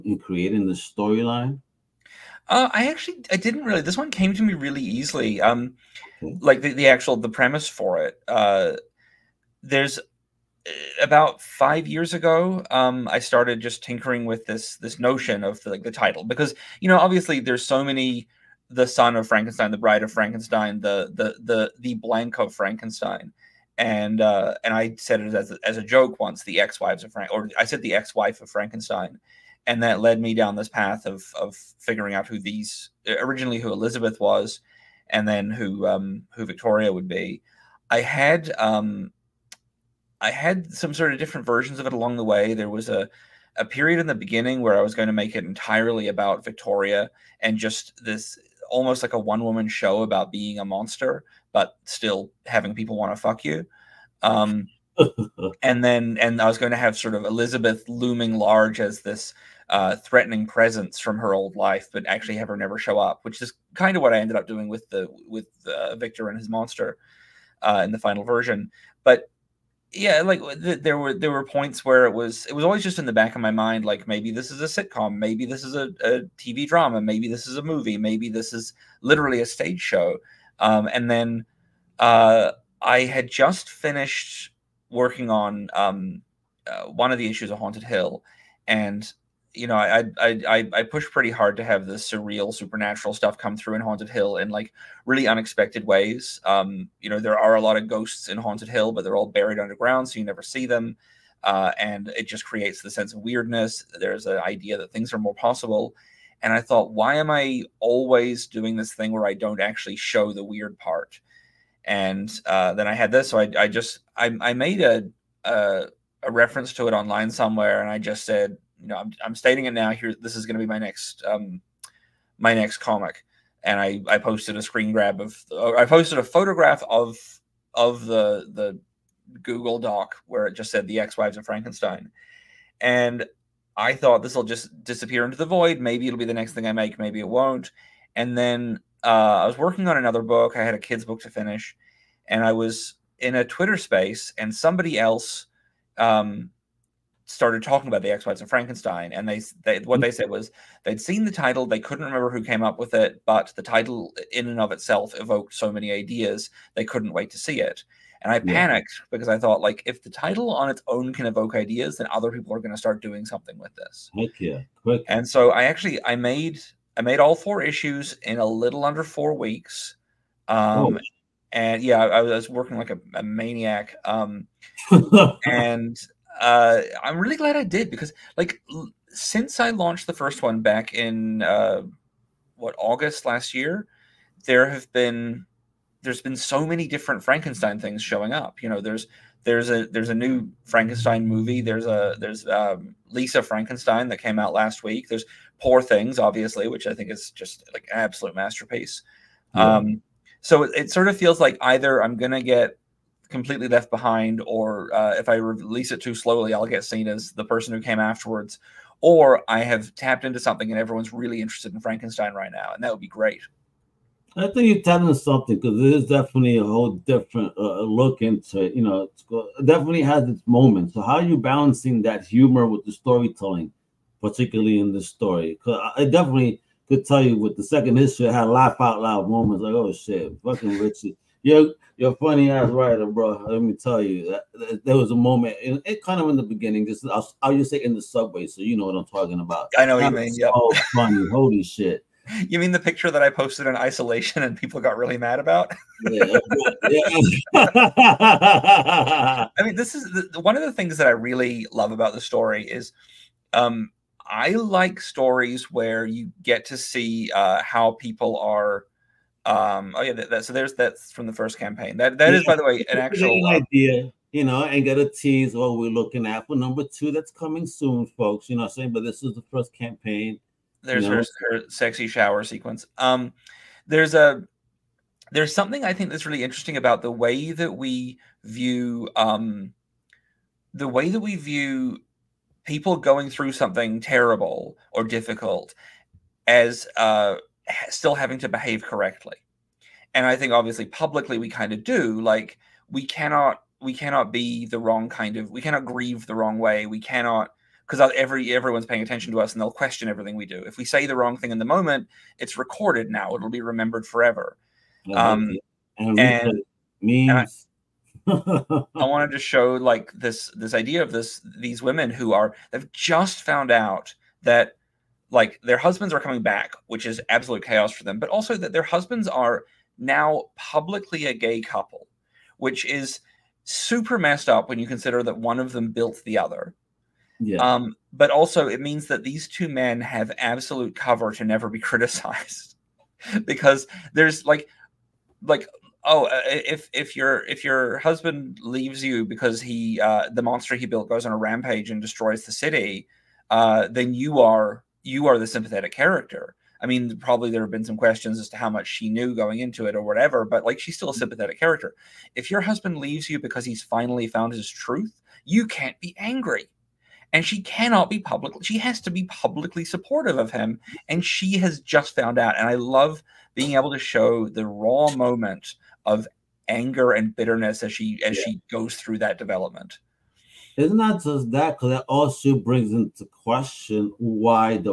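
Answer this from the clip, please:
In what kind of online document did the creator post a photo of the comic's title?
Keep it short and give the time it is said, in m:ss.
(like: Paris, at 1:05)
Google Doc, at 2:09.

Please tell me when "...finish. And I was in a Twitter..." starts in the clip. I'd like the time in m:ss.
2:21.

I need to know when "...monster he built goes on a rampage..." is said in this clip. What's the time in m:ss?
5:40.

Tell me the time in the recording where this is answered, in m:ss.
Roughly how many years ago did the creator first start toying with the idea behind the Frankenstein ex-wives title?
0:11.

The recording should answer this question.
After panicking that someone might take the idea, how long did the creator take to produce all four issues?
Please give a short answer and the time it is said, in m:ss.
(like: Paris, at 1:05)
Under 4 weeks, at 2:48.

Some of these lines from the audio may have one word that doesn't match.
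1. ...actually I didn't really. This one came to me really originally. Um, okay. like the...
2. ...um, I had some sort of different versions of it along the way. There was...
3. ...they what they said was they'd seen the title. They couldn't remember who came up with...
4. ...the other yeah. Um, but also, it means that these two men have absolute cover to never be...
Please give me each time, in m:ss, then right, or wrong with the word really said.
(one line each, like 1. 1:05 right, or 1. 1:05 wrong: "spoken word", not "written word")
1. 0:02 wrong: "easily", not "originally"
2. 0:38 right
3. 2:29 right
4. 5:26 right.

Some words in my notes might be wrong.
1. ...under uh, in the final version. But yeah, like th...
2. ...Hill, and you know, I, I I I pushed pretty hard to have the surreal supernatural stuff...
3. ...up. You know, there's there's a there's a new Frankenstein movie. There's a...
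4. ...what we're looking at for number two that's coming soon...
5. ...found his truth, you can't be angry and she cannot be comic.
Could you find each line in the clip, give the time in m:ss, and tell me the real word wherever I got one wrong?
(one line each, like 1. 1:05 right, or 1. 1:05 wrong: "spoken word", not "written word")
1. 1:06 wrong: "monster", not "under"
2. 1:27 right
3. 3:08 right
4. 4:25 right
5. 5:54 wrong: "public", not "comic".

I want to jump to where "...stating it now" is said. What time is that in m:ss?
1:59.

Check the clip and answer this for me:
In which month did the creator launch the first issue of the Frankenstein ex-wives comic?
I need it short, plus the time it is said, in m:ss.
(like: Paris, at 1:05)
August, at 3:02.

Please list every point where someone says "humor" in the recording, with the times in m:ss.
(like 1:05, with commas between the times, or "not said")
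3:42.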